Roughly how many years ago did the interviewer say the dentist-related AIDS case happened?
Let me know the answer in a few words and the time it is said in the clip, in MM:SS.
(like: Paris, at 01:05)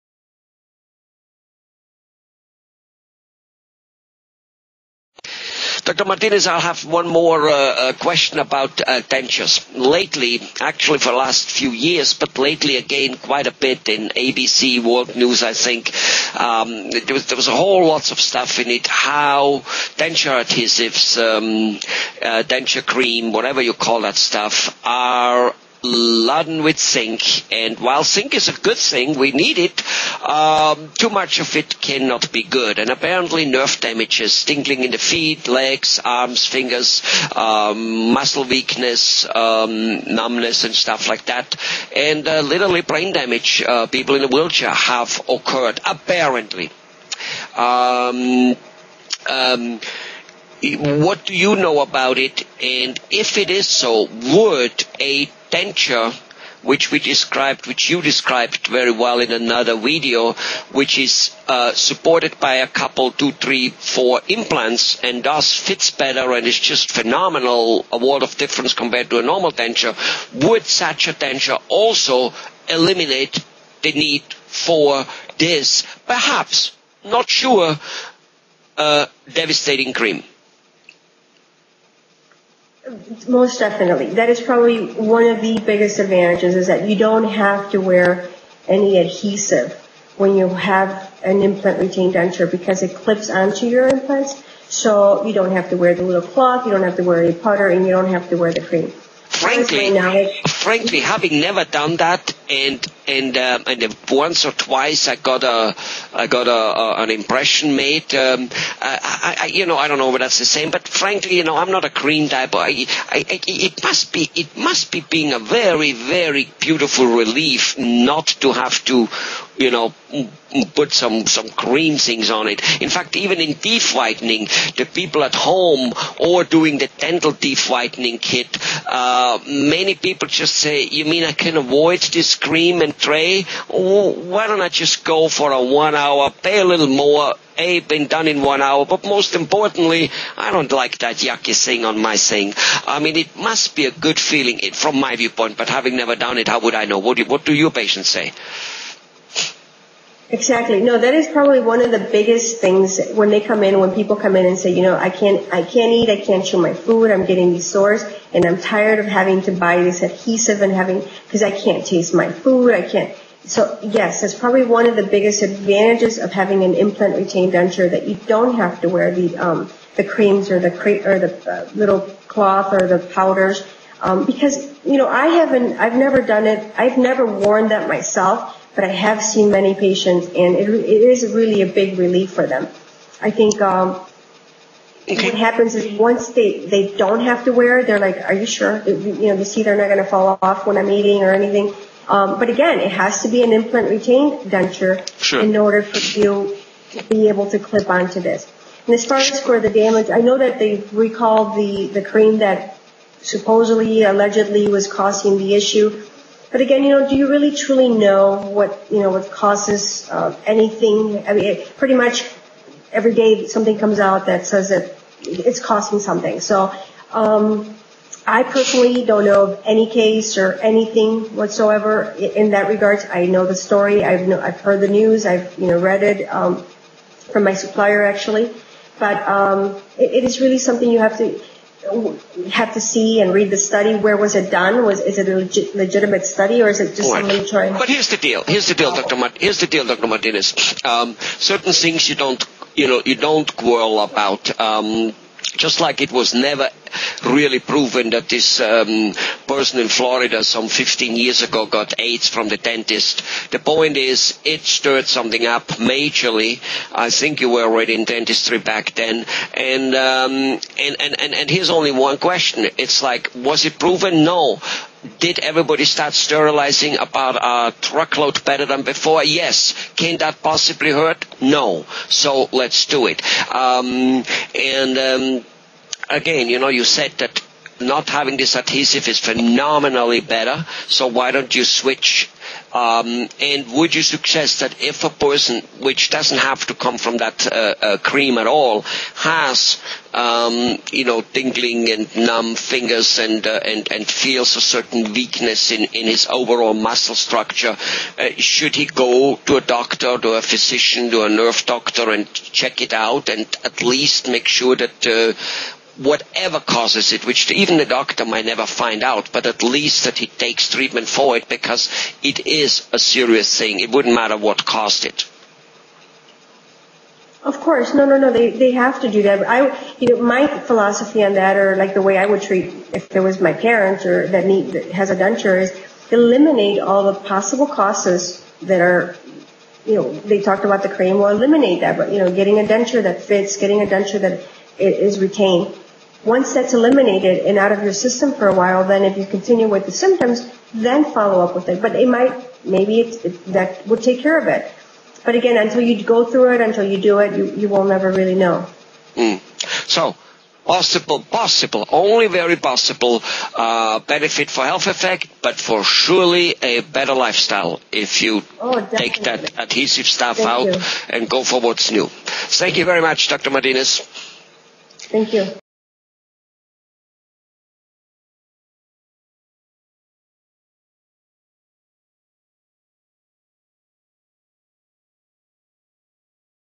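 15 years, at 04:10.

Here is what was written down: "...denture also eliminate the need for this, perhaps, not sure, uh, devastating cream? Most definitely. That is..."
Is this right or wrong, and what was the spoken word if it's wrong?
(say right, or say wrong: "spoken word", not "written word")
right.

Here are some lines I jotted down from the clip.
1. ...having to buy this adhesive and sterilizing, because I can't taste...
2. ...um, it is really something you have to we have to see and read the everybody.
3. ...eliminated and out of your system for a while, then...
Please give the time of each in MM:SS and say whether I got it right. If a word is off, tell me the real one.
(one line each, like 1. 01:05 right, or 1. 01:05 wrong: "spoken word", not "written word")
1. 02:39 wrong: "having", not "sterilizing"
2. 03:49 wrong: "study", not "everybody"
3. 05:36 right.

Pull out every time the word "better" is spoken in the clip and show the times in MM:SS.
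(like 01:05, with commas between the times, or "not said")
01:05, 04:28, 04:40, 05:56.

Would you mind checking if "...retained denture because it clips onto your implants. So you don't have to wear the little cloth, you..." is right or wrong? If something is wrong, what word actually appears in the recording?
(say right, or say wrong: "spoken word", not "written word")
right.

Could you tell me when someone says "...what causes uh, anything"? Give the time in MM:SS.
03:29.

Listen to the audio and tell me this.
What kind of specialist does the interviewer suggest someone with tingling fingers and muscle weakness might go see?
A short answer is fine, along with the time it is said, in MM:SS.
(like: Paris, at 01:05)
Nerve doctor, at 05:01.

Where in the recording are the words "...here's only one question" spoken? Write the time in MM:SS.
04:21.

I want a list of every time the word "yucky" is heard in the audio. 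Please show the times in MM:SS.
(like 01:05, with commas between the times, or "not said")
02:21.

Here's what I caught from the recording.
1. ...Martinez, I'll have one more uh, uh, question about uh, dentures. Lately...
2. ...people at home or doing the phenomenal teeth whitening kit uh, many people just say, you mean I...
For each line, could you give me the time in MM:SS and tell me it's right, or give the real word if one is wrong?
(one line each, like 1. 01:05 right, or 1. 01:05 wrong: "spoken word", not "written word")
1. 00:06 right
2. 02:04 wrong: "dental", not "phenomenal".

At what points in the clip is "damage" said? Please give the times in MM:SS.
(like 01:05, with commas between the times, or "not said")
00:33, 00:43, 03:19.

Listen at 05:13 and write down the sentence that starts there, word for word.
It wouldn't matter what caused it.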